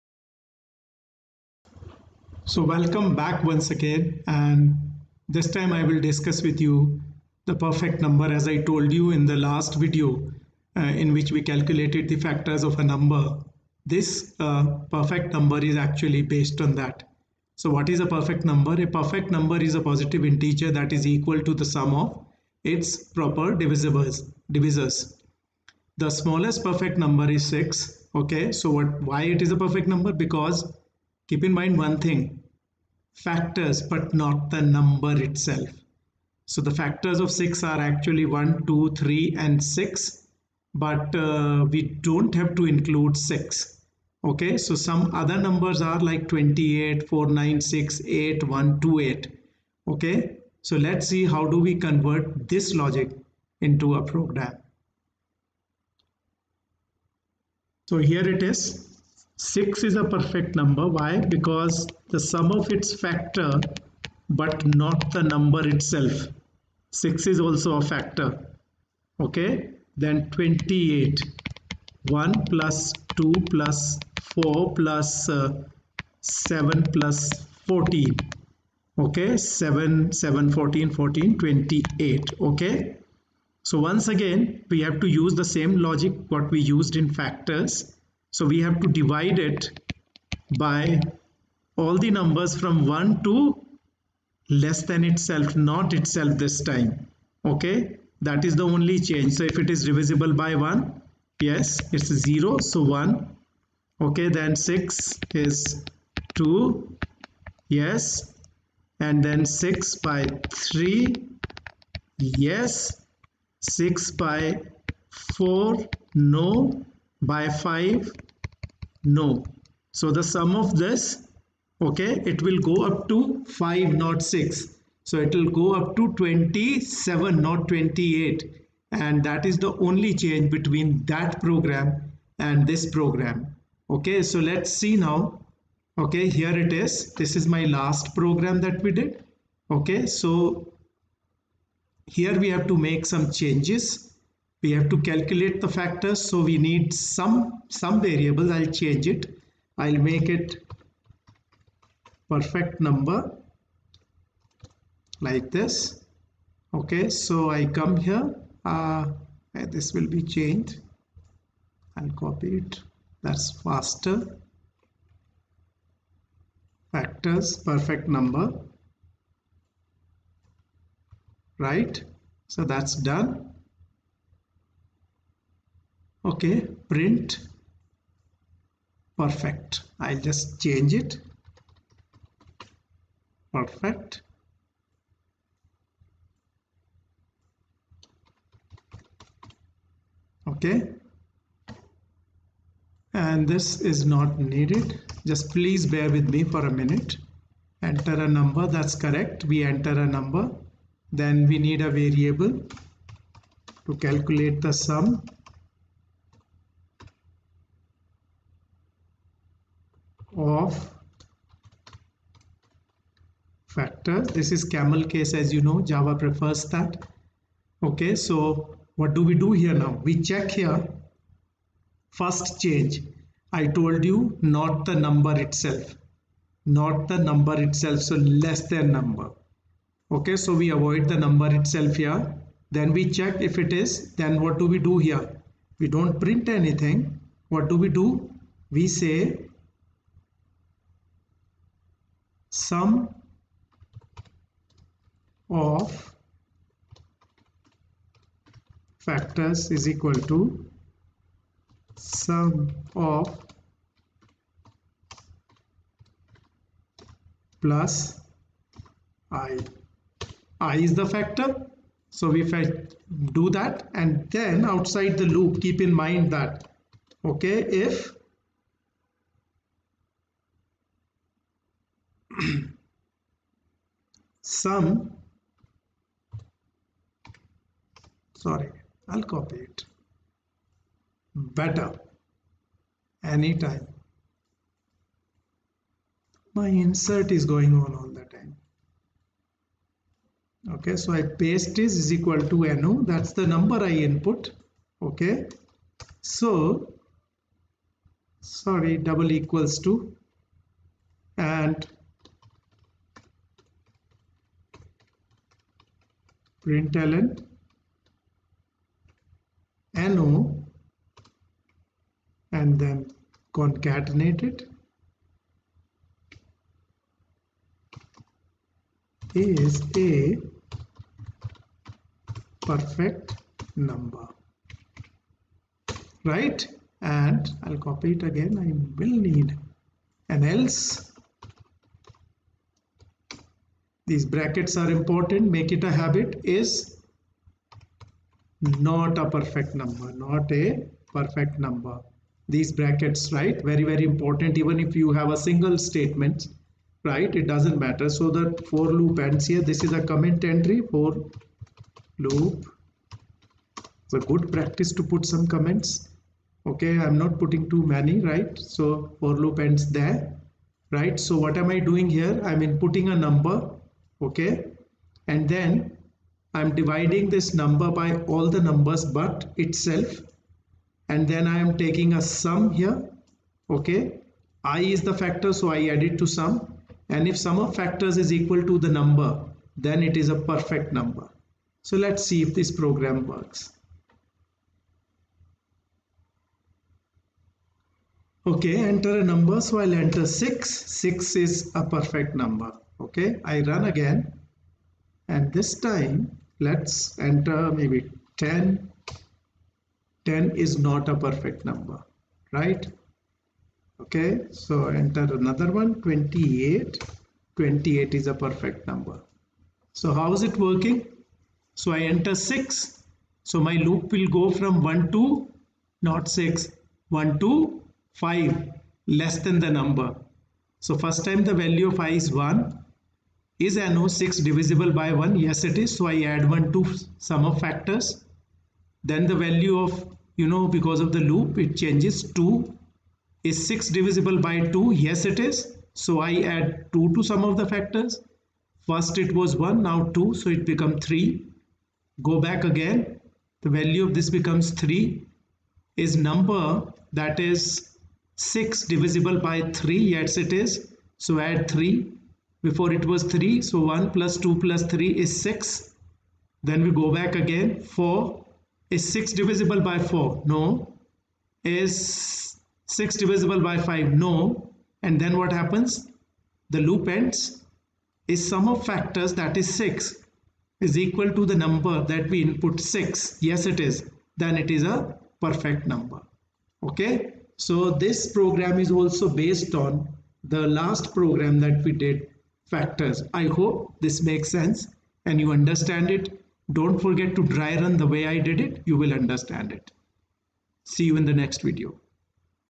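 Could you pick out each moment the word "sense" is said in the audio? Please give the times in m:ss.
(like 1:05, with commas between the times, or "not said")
8:04.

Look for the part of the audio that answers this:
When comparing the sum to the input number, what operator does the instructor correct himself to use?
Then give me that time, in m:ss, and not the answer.
4:59.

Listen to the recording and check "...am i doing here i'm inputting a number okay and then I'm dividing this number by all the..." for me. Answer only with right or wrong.
right.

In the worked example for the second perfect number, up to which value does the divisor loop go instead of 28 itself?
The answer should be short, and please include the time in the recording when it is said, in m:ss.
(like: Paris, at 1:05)
27, at 2:06.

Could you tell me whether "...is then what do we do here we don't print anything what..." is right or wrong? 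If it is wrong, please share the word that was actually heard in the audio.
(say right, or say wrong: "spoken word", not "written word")
right.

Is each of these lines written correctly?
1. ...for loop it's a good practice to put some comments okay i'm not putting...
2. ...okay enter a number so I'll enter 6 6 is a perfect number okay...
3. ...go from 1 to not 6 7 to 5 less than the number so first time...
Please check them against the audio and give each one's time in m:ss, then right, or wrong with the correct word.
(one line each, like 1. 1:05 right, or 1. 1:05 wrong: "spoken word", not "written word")
1. 5:50 right
2. 6:28 right
3. 6:54 wrong: "1", not "7".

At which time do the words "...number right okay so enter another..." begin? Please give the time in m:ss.
6:41.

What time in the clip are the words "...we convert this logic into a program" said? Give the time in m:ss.
0:51.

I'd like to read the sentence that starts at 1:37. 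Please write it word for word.
Okay, that is the only change.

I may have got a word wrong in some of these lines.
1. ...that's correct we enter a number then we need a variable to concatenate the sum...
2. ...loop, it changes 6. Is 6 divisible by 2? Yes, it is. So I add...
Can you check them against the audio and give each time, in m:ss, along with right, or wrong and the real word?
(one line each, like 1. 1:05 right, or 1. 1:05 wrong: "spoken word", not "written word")
1. 3:18 wrong: "calculate", not "concatenate"
2. 7:11 wrong: "2", not "6".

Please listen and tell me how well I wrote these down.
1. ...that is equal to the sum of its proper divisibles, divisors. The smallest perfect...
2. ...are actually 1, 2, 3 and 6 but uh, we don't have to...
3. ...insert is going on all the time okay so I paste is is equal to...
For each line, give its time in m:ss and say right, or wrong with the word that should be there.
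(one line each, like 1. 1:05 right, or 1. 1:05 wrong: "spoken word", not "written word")
1. 0:20 right
2. 0:37 right
3. 4:46 right.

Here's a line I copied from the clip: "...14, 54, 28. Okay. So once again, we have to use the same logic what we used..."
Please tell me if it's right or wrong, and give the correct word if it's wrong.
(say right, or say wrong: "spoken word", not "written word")
wrong: "14", not "54".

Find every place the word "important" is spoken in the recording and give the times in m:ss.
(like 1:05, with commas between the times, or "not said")
5:34, 5:44.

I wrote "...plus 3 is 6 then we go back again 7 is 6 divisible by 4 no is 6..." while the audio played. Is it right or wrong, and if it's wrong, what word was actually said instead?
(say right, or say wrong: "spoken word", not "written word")
wrong: "4", not "7".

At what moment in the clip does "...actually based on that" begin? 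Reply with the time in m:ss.
0:15.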